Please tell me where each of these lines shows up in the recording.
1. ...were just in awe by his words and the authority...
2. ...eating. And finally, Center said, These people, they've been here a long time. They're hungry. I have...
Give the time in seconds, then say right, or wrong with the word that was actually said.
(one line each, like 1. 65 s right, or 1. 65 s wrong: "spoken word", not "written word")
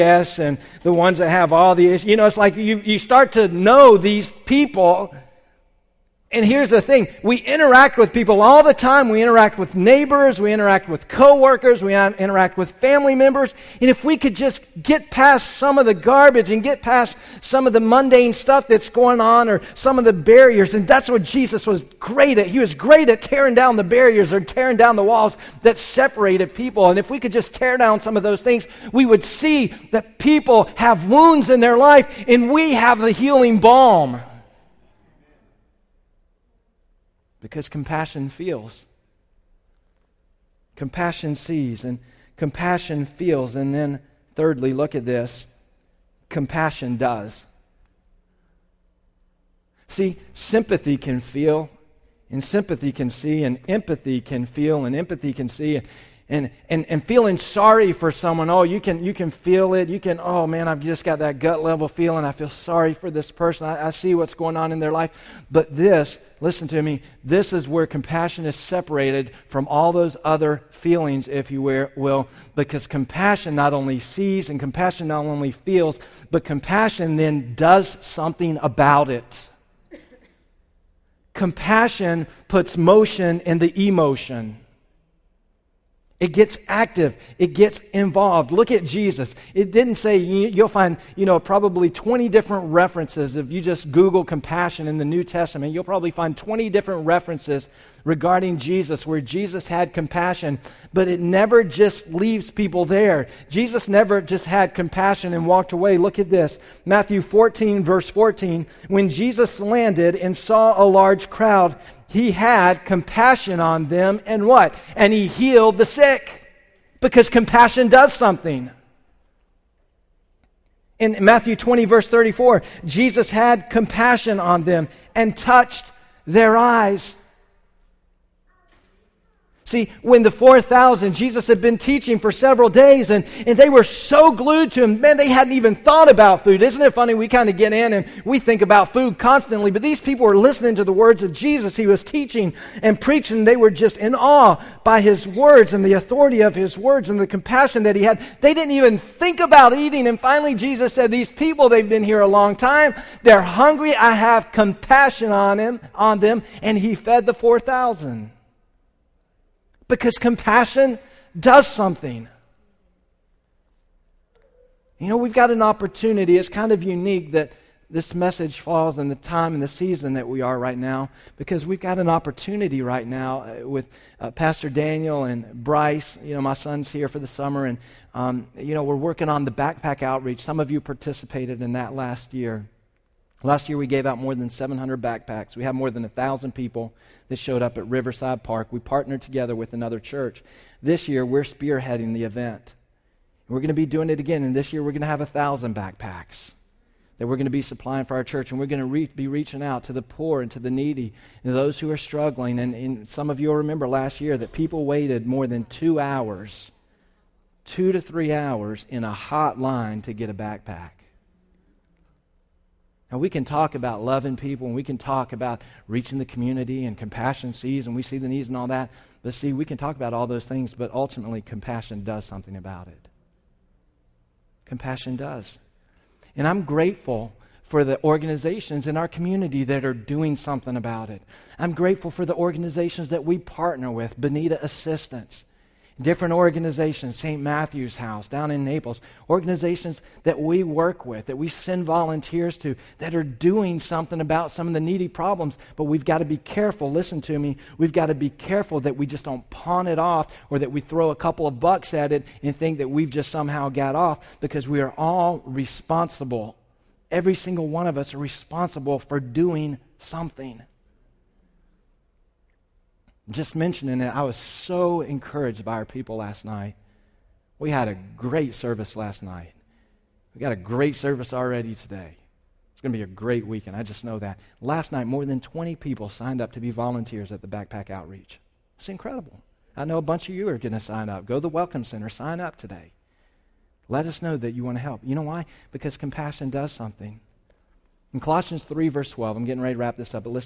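1. 143 s right
2. 149 s wrong: "Jesus", not "Center".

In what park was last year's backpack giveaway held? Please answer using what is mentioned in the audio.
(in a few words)
Riverside Park.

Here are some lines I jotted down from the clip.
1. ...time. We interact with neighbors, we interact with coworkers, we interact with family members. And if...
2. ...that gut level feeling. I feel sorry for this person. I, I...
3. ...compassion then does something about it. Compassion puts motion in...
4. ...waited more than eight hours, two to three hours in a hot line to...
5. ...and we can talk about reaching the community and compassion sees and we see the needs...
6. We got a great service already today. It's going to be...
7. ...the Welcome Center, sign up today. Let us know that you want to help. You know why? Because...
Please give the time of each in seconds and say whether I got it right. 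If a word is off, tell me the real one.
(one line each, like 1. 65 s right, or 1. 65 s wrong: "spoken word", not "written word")
1. 8 s right
2. 61 s right
3. 76 s right
4. 204 s wrong: "two", not "eight"
5. 214 s right
6. 270 s right
7. 281 s right.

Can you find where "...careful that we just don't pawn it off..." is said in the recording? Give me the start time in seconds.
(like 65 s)
248 s.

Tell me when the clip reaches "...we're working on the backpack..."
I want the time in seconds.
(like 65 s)
178 s.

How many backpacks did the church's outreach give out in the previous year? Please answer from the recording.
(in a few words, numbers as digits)
700.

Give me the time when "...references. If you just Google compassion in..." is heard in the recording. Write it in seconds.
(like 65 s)
92 s.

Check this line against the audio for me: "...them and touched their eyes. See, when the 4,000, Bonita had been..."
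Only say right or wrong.
wrong.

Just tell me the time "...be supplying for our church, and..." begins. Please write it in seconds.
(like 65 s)
197 s.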